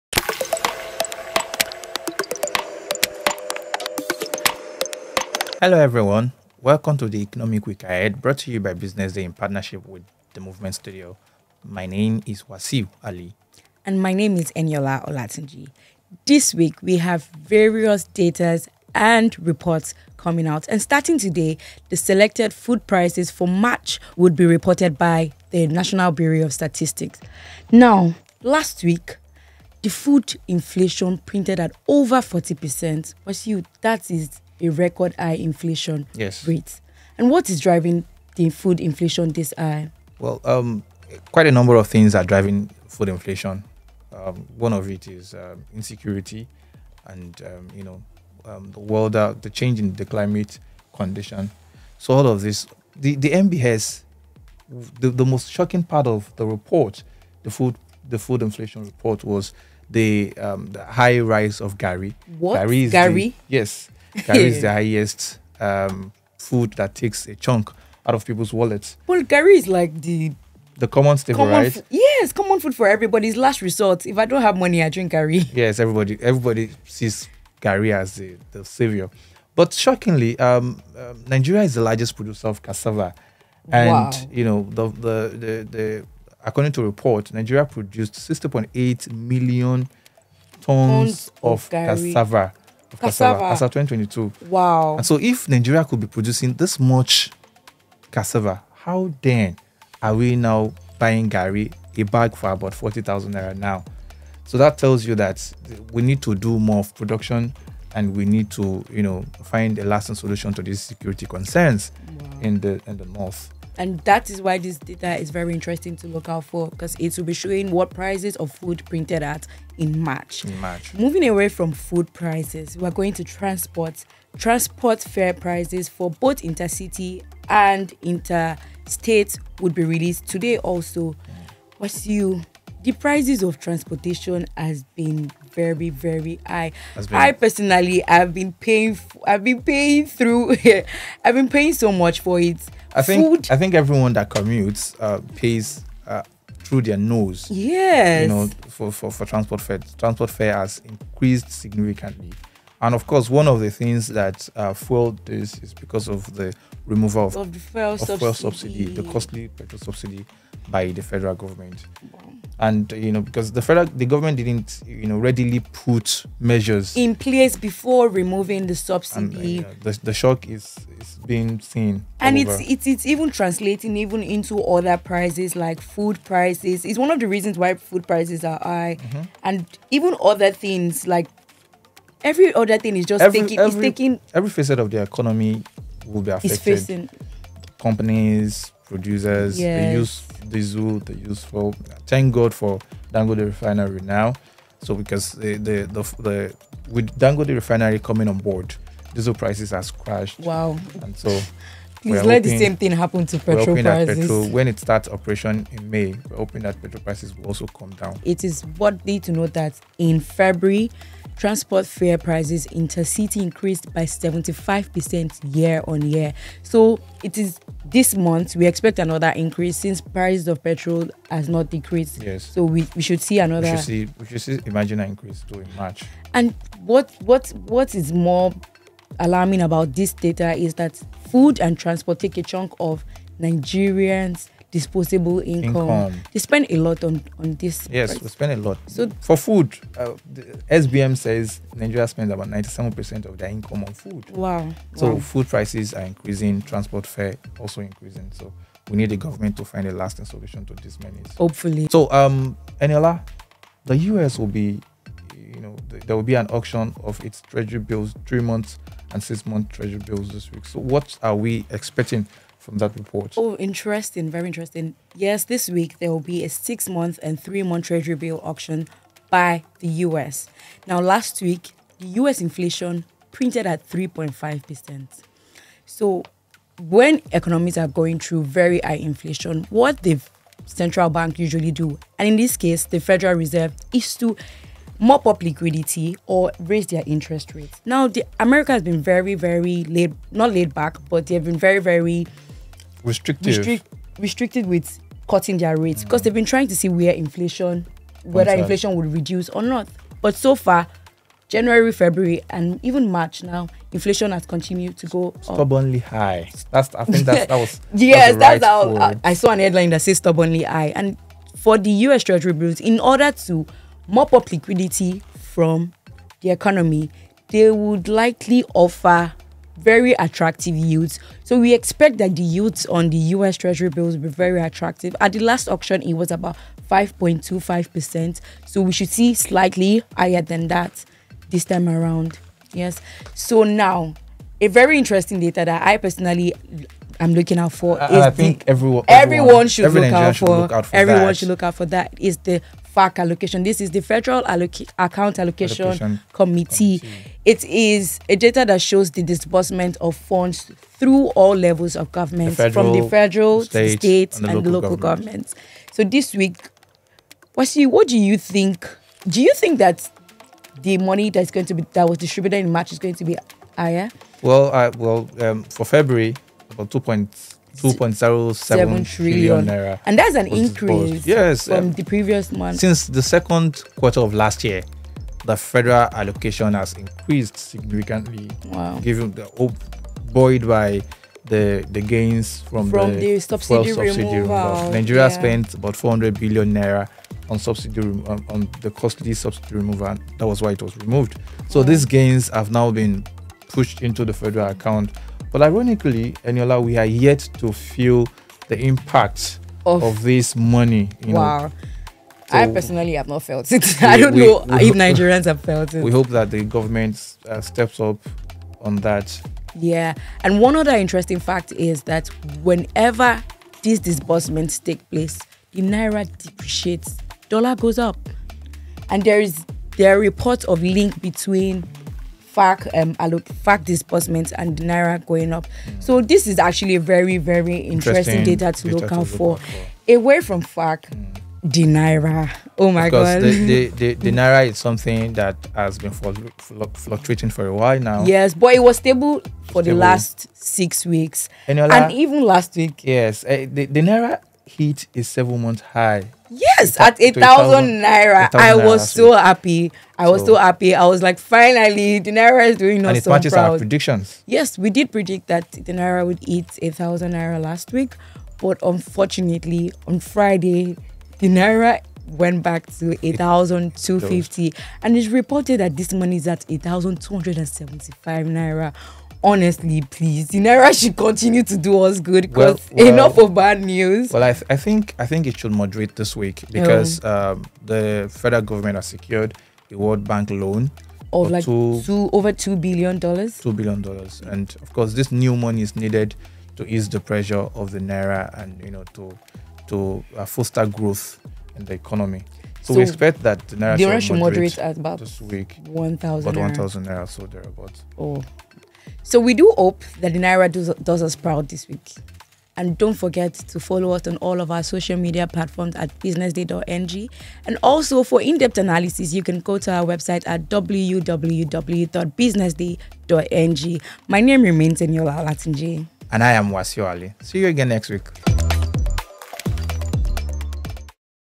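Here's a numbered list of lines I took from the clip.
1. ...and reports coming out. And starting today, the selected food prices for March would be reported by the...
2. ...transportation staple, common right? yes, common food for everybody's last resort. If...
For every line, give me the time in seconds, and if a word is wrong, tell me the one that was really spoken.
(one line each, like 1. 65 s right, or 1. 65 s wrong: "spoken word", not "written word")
1. 18 s right
2. 70 s wrong: "common", not "transportation".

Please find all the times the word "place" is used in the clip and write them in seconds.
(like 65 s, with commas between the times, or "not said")
167 s, 415 s.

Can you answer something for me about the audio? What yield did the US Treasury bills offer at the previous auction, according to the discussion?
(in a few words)
5.25%.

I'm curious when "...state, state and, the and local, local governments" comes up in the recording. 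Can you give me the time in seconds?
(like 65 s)
353 s.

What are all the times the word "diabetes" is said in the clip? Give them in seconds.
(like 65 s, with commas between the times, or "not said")
not said.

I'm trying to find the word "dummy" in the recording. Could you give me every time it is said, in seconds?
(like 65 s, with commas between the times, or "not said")
not said.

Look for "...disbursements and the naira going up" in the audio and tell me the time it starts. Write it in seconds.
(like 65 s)
423 s.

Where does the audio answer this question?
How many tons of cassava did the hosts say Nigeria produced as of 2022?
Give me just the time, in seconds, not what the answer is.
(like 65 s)
88 s.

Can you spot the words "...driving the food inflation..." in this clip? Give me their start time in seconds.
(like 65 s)
37 s.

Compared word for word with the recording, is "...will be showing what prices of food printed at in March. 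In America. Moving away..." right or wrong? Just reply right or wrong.
wrong.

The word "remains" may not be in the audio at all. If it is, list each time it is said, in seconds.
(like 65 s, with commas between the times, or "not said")
514 s.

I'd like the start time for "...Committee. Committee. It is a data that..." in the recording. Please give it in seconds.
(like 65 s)
346 s.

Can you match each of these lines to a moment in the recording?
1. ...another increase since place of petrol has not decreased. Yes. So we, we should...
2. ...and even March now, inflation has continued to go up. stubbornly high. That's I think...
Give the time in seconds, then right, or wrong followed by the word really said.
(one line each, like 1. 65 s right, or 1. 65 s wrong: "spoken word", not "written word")
1. 218 s wrong: "price", not "place"
2. 302 s right.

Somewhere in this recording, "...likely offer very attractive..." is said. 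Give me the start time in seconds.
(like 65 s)
318 s.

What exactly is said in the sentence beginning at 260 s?
So what are we expecting from that report?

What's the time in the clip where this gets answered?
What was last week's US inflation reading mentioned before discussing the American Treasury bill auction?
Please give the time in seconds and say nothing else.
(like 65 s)
273 s.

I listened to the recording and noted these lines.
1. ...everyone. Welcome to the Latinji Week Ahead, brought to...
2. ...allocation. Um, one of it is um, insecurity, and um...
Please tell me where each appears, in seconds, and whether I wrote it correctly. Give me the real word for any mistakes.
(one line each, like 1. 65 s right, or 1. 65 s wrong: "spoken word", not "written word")
1. 5 s wrong: "Economic", not "Latinji"
2. 43 s wrong: "inflation", not "allocation".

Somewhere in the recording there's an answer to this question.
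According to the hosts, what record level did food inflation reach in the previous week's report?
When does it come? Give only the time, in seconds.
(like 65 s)
31 s.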